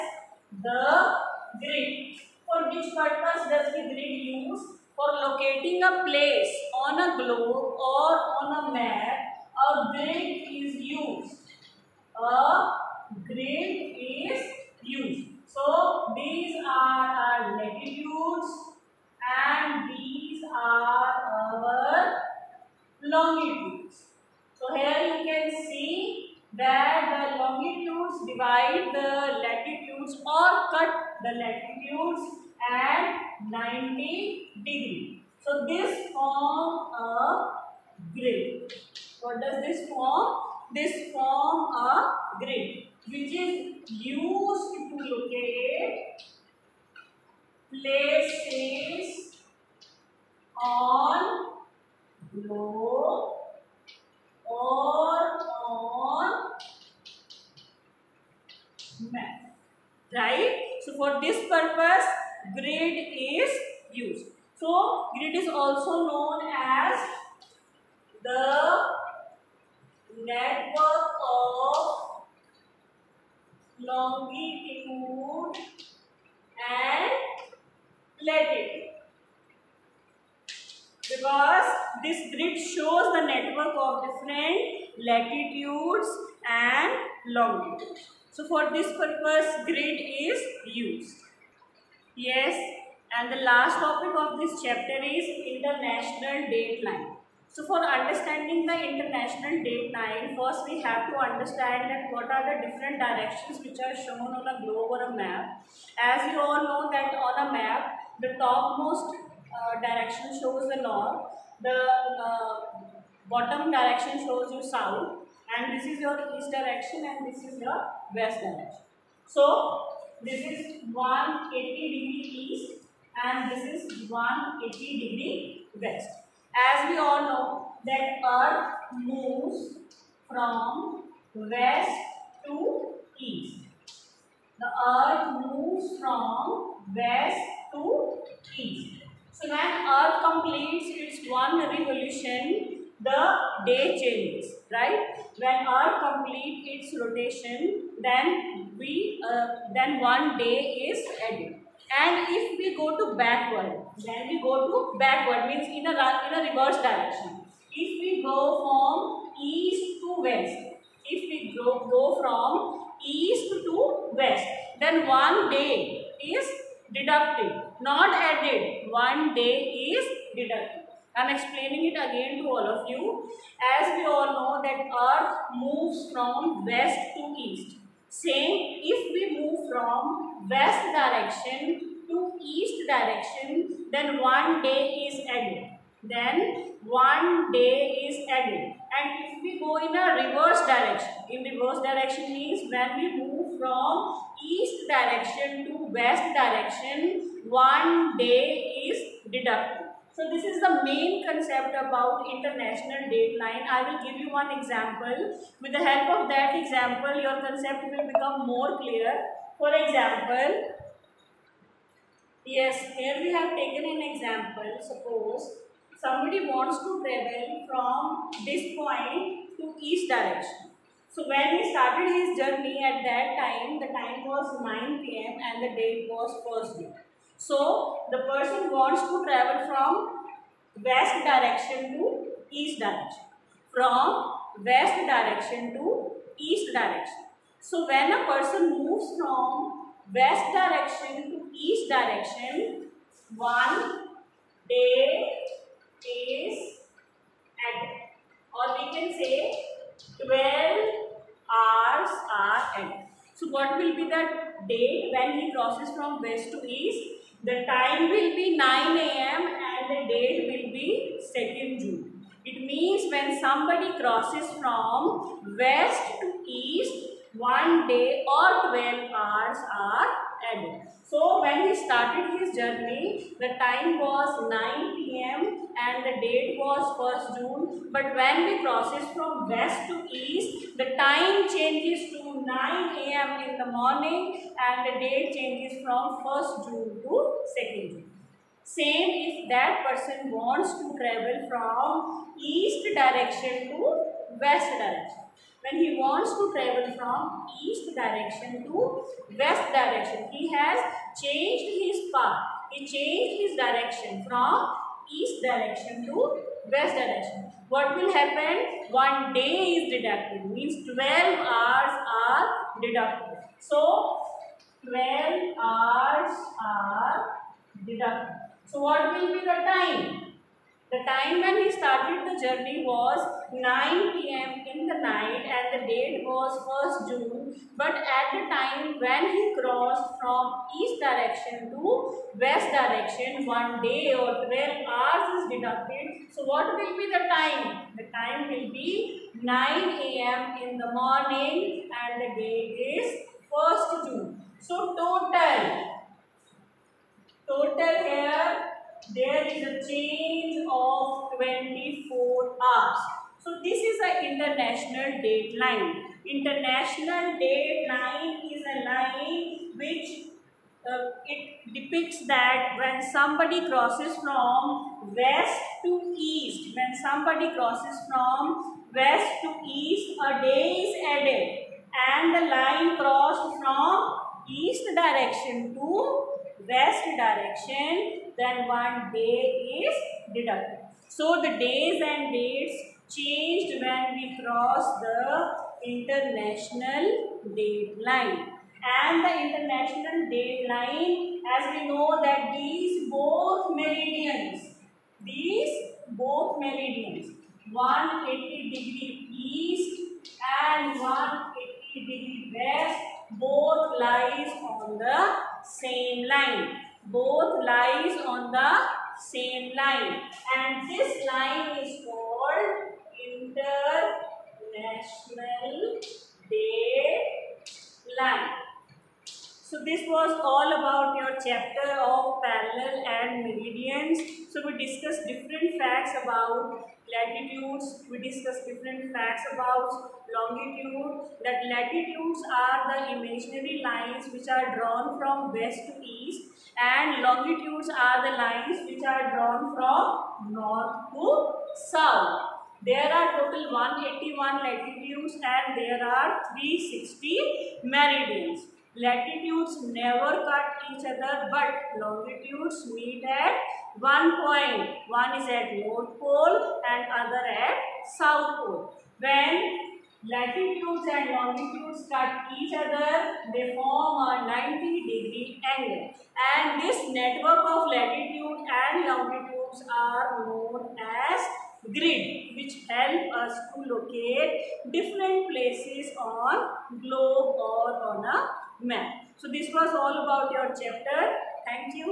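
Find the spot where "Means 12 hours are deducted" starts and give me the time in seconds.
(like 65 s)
310 s.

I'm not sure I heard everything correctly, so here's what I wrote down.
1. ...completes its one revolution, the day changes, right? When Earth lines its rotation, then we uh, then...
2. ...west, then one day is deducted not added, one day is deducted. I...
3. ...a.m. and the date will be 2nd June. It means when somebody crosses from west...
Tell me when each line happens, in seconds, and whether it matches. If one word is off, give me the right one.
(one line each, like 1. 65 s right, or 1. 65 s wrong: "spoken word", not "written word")
1. 140 s wrong: "completes", not "lines"
2. 164 s right
3. 258 s right.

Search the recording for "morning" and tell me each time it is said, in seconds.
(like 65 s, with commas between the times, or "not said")
283 s, 340 s.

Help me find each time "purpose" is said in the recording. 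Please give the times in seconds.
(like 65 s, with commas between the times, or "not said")
2 s, 88 s.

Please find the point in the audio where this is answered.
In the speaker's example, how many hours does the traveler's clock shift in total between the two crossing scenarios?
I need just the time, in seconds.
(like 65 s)
351 s.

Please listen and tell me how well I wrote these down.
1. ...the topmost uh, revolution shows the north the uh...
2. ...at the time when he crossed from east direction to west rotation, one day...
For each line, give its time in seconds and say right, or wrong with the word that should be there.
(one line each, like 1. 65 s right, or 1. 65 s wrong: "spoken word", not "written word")
1. 108 s wrong: "direction", not "revolution"
2. 328 s wrong: "direction", not "rotation".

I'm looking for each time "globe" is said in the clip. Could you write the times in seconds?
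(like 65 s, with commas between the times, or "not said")
7 s, 104 s, 477 s.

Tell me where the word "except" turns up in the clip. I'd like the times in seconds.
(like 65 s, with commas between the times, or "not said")
not said.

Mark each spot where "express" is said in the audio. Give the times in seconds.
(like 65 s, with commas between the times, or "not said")
not said.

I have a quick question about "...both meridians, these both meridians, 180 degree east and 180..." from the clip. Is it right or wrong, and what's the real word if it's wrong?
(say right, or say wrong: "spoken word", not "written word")
right.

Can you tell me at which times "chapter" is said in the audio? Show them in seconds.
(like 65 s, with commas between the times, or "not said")
94 s, 421 s, 480 s.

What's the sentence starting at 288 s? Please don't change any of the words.
Same if that person wants to travel from east direction to west direction.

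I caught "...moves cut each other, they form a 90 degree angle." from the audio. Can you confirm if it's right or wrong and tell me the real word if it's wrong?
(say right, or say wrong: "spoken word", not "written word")
wrong: "longitudes", not "moves".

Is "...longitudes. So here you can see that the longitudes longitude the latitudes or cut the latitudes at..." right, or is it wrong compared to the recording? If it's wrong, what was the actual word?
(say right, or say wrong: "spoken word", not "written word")
wrong: "divide", not "longitude".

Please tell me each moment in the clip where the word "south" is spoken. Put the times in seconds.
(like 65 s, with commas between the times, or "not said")
114 s, 441 s, 458 s.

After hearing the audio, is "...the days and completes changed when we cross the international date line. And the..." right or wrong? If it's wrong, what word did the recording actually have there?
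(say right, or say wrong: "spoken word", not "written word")
wrong: "dates", not "completes".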